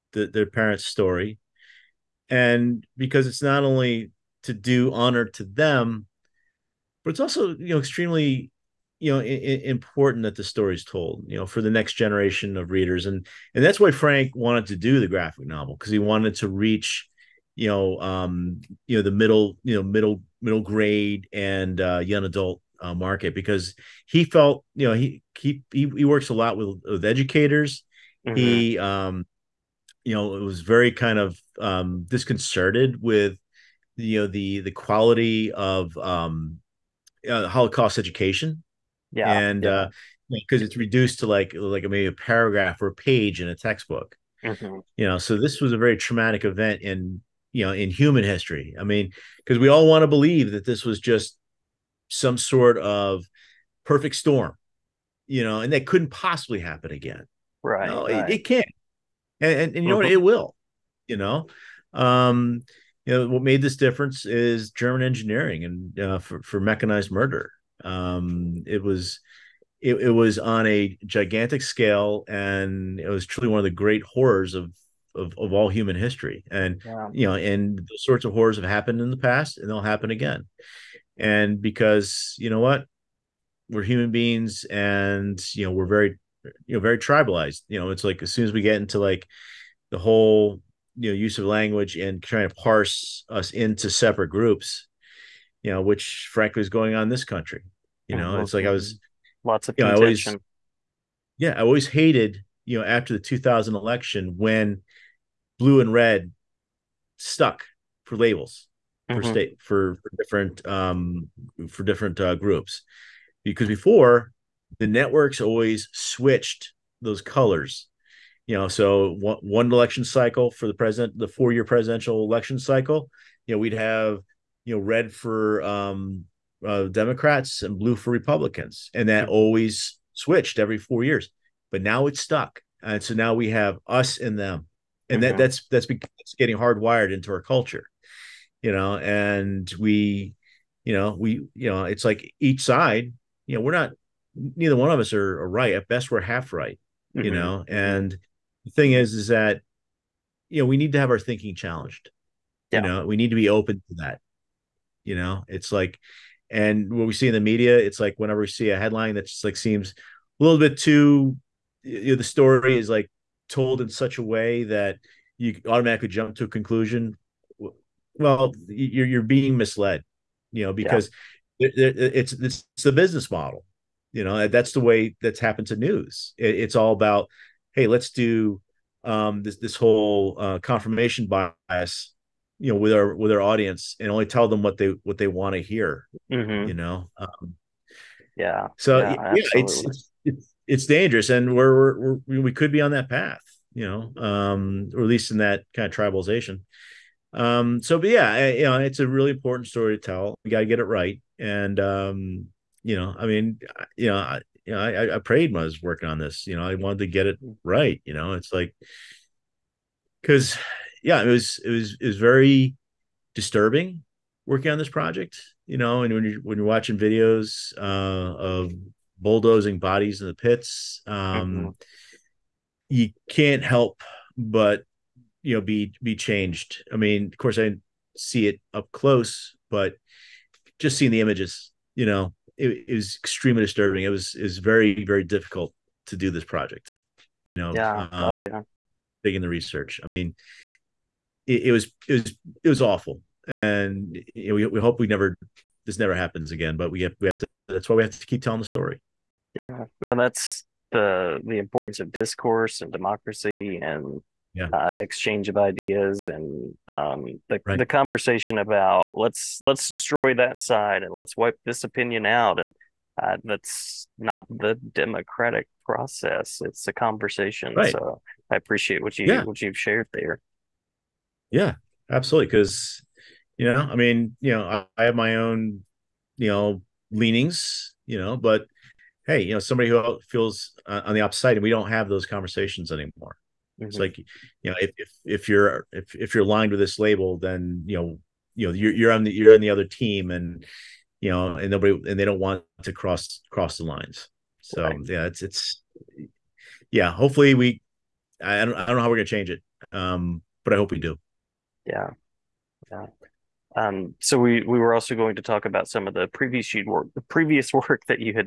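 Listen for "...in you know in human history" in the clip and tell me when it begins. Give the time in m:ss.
0:46.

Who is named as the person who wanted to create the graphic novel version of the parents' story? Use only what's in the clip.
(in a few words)
Frank.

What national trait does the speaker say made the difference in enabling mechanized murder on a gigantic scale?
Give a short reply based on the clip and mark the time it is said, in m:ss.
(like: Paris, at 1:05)
German engineering, at 1:04.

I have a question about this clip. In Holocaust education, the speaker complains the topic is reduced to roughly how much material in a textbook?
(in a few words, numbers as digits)
a paragraph or a page.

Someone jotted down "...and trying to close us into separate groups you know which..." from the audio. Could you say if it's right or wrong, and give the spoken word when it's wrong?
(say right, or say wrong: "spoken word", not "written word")
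wrong: "parse", not "close".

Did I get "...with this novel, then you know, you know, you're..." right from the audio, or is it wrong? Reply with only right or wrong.
wrong.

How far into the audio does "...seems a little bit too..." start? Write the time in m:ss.
2:39.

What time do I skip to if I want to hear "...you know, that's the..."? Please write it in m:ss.
2:54.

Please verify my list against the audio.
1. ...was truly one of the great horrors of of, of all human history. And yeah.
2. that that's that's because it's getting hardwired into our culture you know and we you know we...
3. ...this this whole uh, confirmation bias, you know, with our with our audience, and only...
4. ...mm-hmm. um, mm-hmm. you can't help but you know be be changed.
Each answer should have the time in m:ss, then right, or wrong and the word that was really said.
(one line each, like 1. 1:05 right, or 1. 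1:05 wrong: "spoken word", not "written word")
1. 1:13 right
2. 2:15 right
3. 2:59 right
4. 3:41 right.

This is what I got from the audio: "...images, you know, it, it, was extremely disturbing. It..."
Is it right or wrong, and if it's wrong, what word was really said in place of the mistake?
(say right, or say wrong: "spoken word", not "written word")
right.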